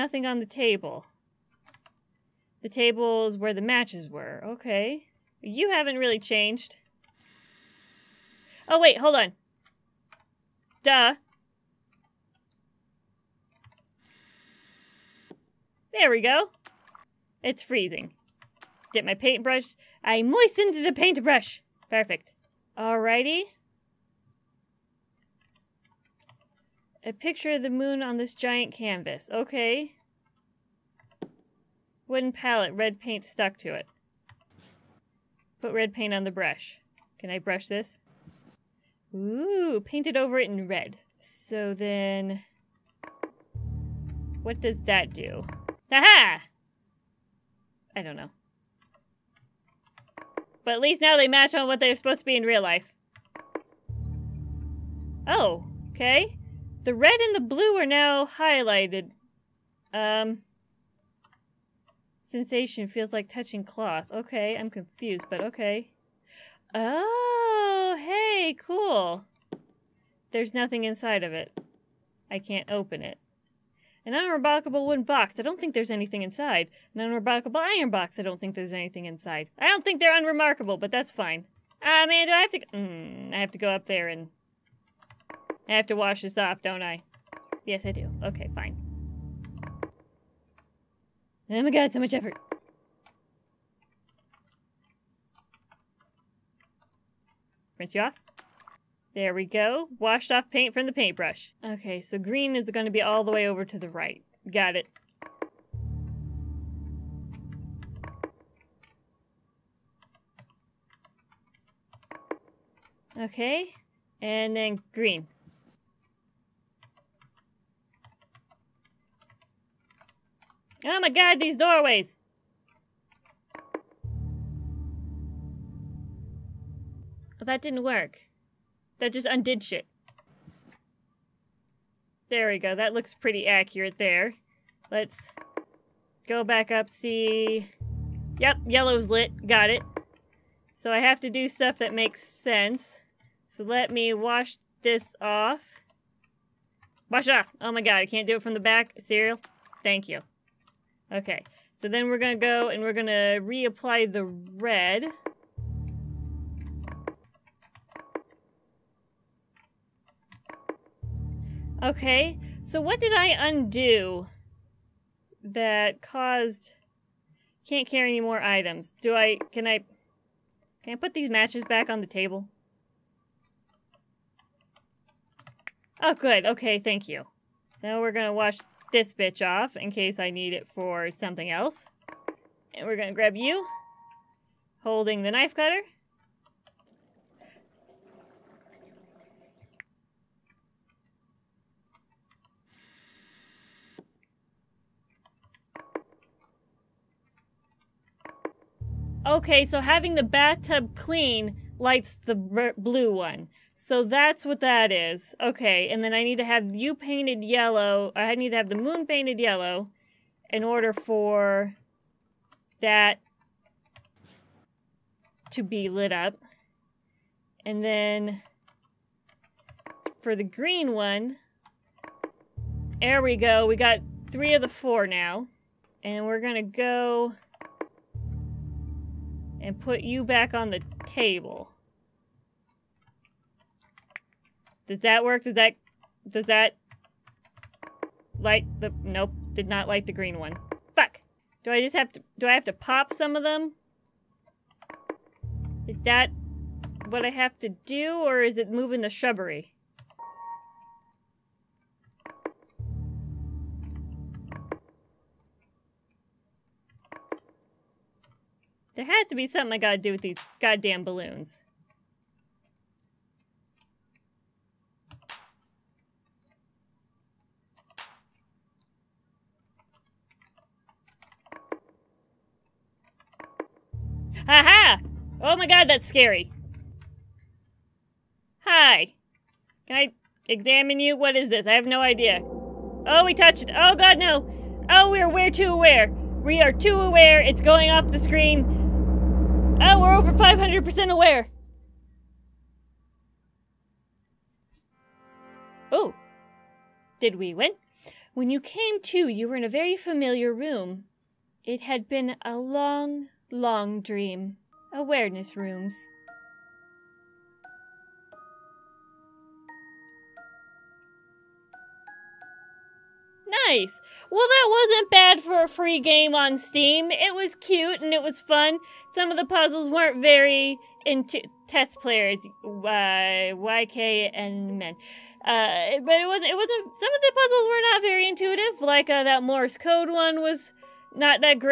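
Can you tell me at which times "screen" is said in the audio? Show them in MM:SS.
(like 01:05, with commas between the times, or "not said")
04:48.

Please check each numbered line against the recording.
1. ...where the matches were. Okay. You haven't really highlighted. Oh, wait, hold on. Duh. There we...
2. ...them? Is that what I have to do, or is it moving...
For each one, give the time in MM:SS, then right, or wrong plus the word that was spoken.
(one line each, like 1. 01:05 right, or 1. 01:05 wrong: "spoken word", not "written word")
1. 00:03 wrong: "changed", not "highlighted"
2. 04:03 right.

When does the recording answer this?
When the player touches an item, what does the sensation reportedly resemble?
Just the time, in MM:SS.
01:03.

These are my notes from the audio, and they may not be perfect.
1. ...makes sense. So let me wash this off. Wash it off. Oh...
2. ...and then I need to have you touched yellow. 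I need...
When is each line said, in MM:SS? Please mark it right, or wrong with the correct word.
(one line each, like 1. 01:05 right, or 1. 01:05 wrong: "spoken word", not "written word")
1. 02:21 right
2. 03:25 wrong: "painted", not "touched".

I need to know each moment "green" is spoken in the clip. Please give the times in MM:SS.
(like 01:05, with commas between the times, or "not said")
01:42, 01:54, 03:40, 04:00.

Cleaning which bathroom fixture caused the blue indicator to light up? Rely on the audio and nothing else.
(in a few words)
The bathtub.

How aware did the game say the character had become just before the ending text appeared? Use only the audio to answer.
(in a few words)
Over 500%.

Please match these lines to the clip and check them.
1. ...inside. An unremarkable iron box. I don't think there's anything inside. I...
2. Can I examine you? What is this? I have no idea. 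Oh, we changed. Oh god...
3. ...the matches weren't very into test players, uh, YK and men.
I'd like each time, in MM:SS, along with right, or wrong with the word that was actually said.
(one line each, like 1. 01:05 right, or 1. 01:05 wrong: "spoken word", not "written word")
1. 01:16 right
2. 04:39 wrong: "touched", not "changed"
3. 05:19 wrong: "puzzles", not "matches".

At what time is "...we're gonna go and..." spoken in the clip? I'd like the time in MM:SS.
02:32.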